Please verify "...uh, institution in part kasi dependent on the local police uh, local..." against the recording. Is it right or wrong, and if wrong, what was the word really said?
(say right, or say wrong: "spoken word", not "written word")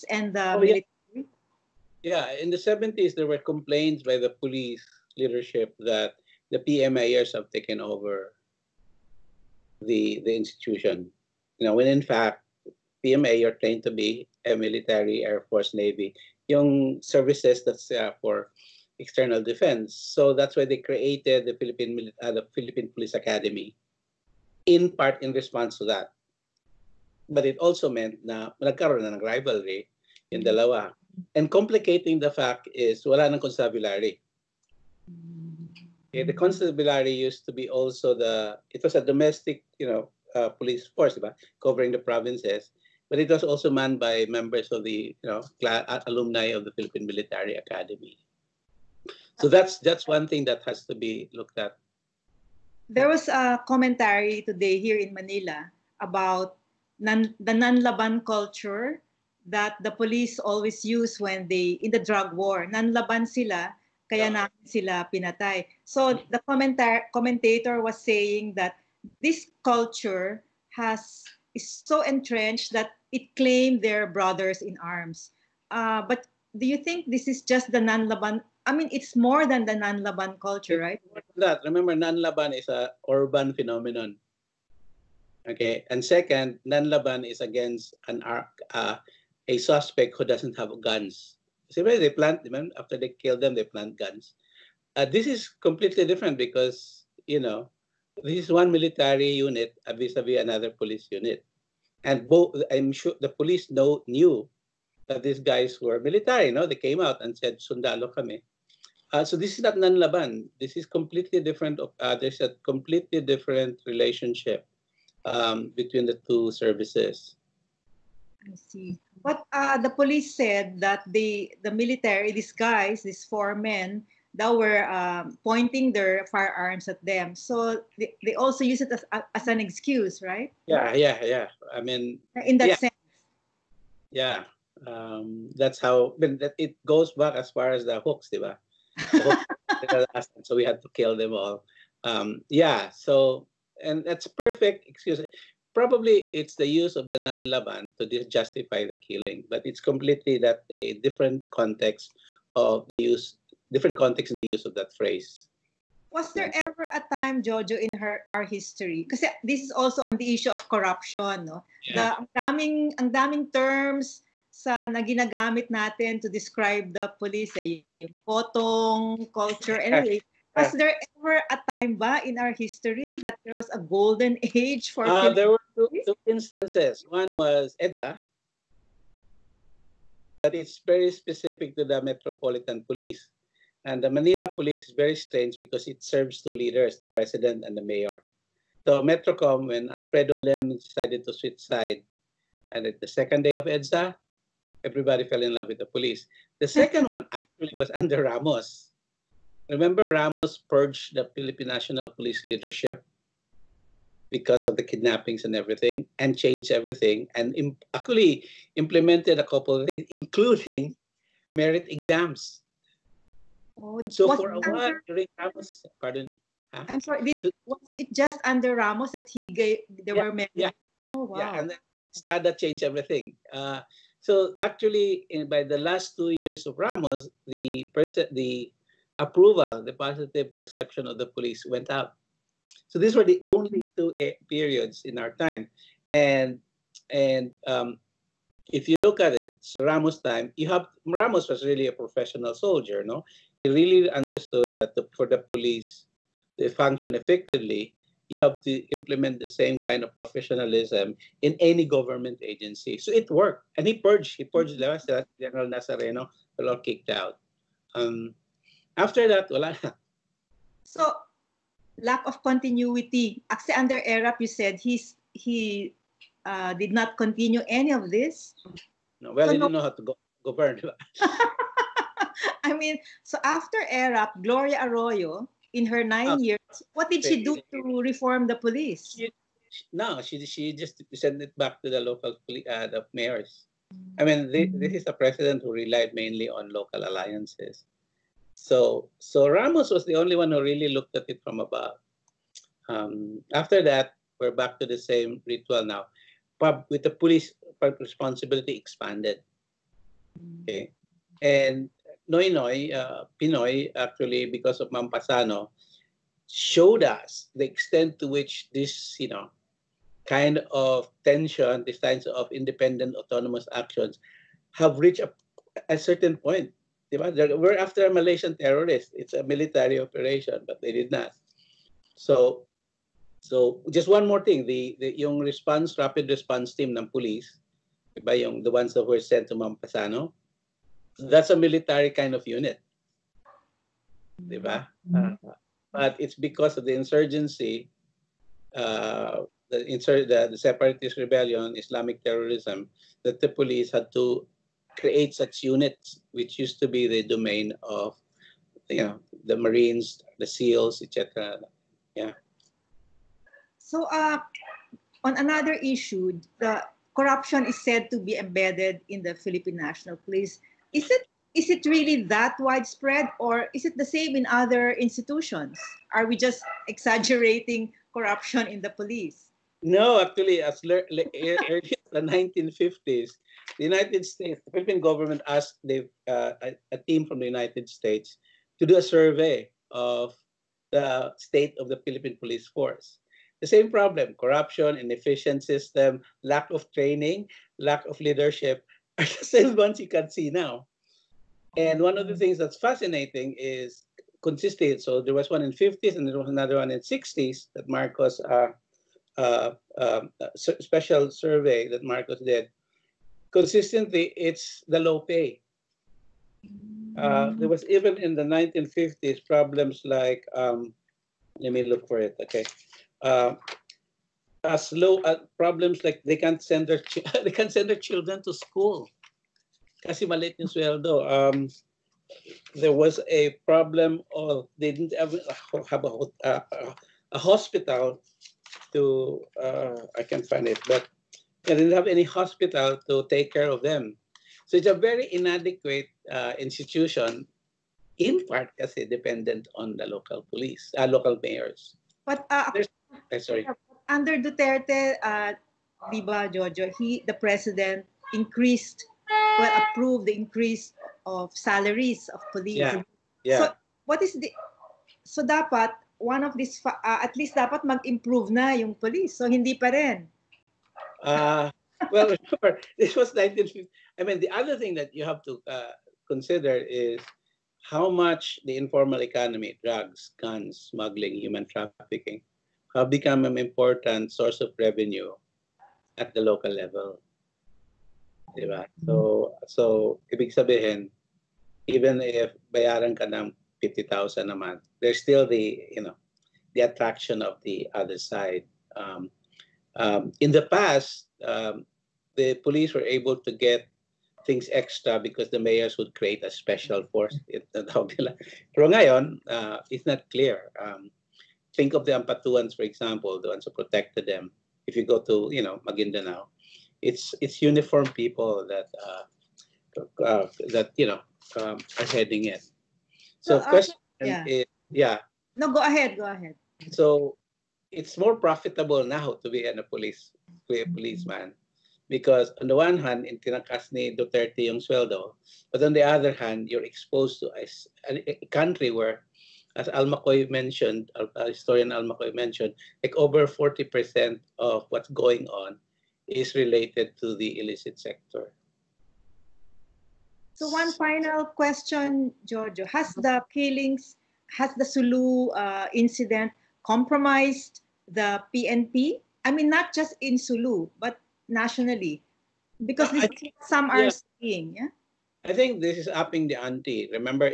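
right.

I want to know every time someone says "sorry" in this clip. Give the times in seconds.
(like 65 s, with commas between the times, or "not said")
217 s, 443 s.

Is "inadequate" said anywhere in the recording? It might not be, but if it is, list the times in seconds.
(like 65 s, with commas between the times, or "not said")
435 s.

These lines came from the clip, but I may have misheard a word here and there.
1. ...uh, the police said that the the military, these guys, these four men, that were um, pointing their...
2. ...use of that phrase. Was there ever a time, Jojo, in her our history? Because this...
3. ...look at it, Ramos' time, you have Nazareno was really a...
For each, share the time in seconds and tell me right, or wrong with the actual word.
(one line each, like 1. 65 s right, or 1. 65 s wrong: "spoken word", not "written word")
1. 119 s right
2. 154 s right
3. 238 s wrong: "Ramos", not "Nazareno".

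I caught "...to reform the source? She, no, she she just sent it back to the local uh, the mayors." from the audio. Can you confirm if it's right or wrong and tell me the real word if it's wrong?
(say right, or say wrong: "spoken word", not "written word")
wrong: "police", not "source".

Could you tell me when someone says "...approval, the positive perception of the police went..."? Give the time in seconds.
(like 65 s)
229 s.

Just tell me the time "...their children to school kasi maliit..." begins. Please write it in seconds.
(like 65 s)
417 s.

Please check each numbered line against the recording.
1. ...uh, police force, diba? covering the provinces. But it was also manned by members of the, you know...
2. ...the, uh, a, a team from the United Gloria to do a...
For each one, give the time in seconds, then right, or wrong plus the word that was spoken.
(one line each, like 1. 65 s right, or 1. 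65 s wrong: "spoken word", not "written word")
1. 40 s right
2. 375 s wrong: "States", not "Gloria".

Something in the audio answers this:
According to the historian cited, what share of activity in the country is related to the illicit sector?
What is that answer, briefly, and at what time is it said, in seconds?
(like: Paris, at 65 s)
over 40%, at 533 s.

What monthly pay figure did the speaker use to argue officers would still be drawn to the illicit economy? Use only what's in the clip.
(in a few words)
50,000.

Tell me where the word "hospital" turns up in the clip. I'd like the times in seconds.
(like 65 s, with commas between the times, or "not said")
427 s, 432 s.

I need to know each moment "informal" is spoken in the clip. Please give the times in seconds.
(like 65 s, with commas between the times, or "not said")
468 s.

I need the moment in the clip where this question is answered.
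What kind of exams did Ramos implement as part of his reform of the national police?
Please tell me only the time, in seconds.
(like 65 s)
211 s.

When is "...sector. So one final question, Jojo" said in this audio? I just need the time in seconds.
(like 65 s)
537 s.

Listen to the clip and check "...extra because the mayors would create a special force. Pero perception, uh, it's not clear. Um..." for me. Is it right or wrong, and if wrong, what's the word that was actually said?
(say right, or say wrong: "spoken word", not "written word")
wrong: "ngayon", not "perception".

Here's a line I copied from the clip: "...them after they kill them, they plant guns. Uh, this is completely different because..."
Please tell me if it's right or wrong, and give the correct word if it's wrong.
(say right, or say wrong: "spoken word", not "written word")
right.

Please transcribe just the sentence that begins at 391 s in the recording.
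And one of the things that's fascinating is consistent.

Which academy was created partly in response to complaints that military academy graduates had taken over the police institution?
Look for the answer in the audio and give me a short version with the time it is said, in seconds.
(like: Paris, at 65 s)
Philippine Police Academy, at 22 s.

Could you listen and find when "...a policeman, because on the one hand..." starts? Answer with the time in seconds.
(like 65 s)
520 s.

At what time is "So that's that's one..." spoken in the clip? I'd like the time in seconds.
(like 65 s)
49 s.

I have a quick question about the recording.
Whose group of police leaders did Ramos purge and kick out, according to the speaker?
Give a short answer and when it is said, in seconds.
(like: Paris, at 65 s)
General Nazareno, at 255 s.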